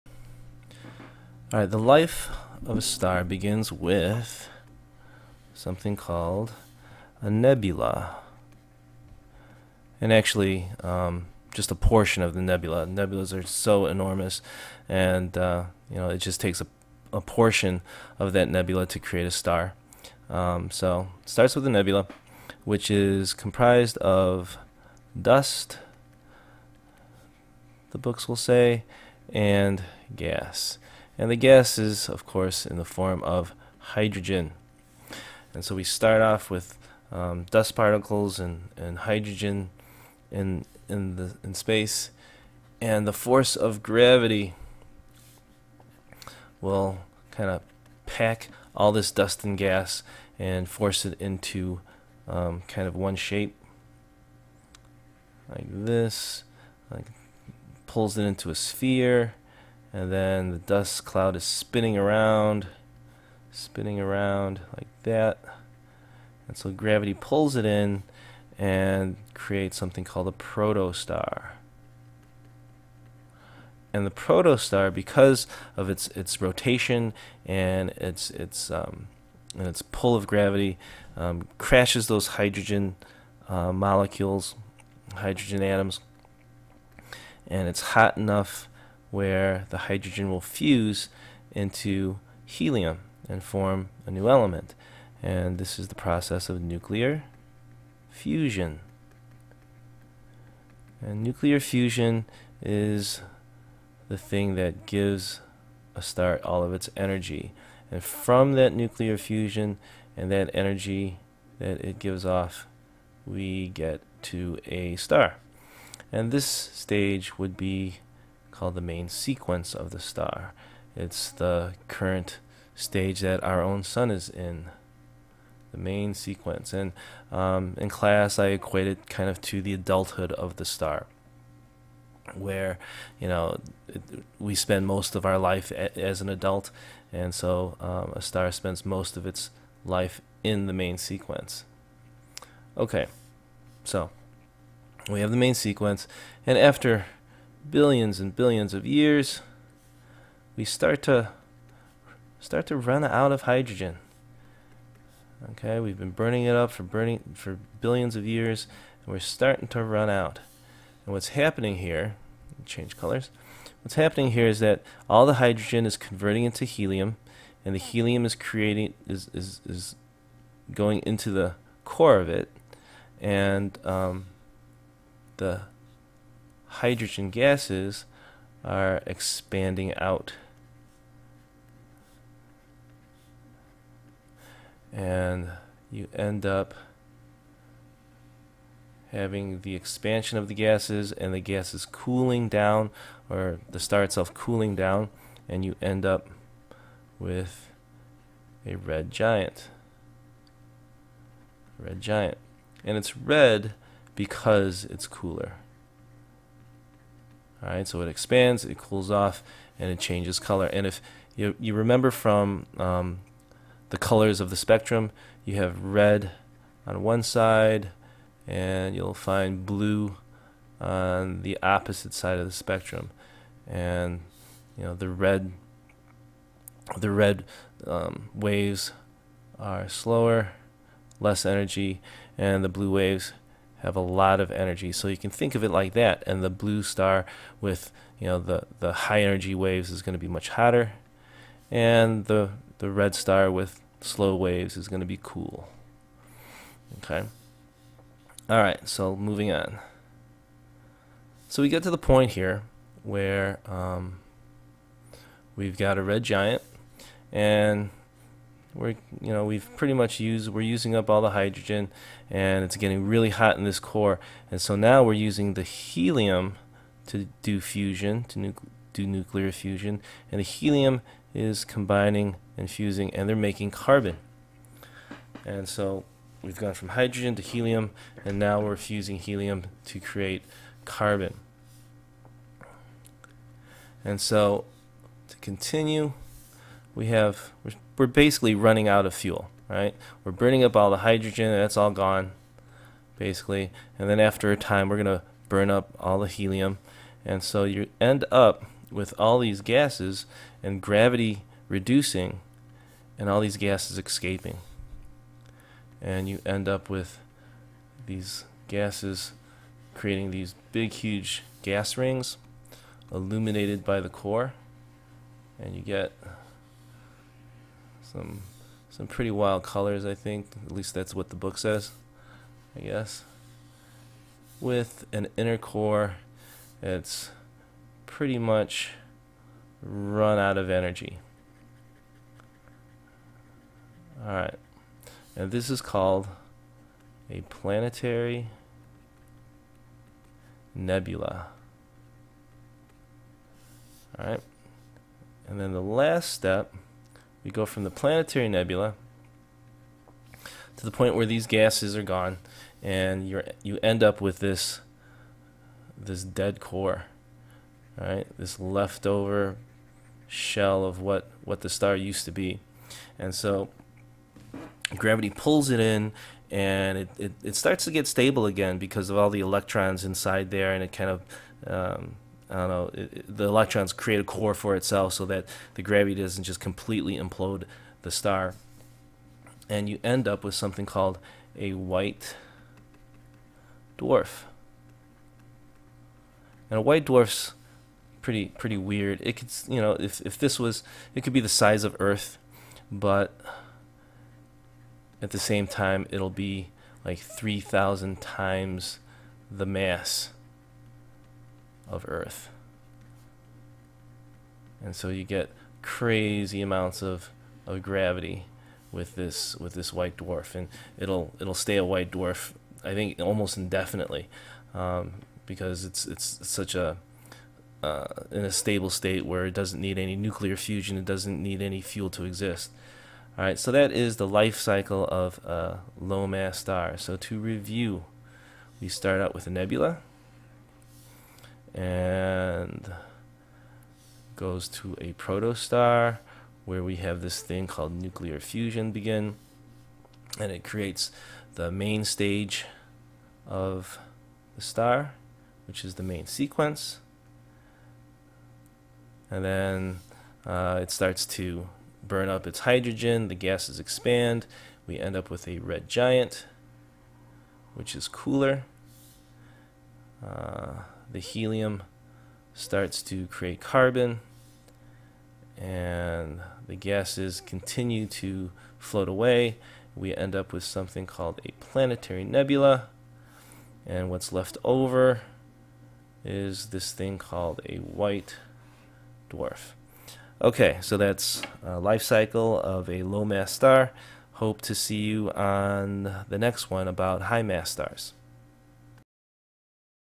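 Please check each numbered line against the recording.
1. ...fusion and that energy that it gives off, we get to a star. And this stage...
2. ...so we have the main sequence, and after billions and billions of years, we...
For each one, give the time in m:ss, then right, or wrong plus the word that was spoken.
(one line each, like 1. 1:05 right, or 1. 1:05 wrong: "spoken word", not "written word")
1. 1:49 right
2. 2:23 right.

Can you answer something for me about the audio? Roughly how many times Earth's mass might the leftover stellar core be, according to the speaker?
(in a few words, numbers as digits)
3,000 times.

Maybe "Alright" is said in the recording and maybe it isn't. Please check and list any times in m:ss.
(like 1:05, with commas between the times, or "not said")
0:01, 5:34, 5:44.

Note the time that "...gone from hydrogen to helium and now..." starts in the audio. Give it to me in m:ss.
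4:36.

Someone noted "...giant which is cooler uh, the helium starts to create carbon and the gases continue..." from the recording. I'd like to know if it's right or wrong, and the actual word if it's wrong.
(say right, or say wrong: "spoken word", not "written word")
right.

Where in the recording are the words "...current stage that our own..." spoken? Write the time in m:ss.
2:01.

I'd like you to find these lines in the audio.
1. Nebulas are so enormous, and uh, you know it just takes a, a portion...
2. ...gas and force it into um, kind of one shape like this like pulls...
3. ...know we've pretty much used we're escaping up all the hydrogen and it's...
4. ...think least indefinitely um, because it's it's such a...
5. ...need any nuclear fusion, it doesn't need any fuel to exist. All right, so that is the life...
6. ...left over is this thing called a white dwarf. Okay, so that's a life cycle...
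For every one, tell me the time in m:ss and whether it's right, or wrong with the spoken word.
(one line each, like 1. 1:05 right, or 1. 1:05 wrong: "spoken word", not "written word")
1. 0:12 right
2. 0:49 right
3. 4:19 wrong: "using", not "escaping"
4. 6:52 wrong: "almost", not "least"
5. 6:59 right
6. 7:54 right.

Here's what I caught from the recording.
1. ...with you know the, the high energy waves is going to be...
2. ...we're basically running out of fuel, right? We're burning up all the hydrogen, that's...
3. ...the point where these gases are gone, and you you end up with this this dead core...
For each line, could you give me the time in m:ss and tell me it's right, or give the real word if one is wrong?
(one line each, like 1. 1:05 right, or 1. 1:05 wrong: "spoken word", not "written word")
1. 3:57 right
2. 4:47 right
3. 5:50 right.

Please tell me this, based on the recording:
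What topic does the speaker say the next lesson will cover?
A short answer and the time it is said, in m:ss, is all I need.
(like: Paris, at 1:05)
high mass stars, at 8:07.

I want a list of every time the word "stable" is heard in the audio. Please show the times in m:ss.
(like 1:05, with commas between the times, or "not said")
6:08, 6:58.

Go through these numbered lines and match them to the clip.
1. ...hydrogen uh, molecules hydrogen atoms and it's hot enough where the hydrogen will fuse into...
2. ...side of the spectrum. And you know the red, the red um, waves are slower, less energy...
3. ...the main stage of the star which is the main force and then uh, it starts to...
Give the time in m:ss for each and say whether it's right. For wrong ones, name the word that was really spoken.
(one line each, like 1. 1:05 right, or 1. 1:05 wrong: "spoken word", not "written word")
1. 1:22 right
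2. 3:42 right
3. 7:21 wrong: "sequence", not "force".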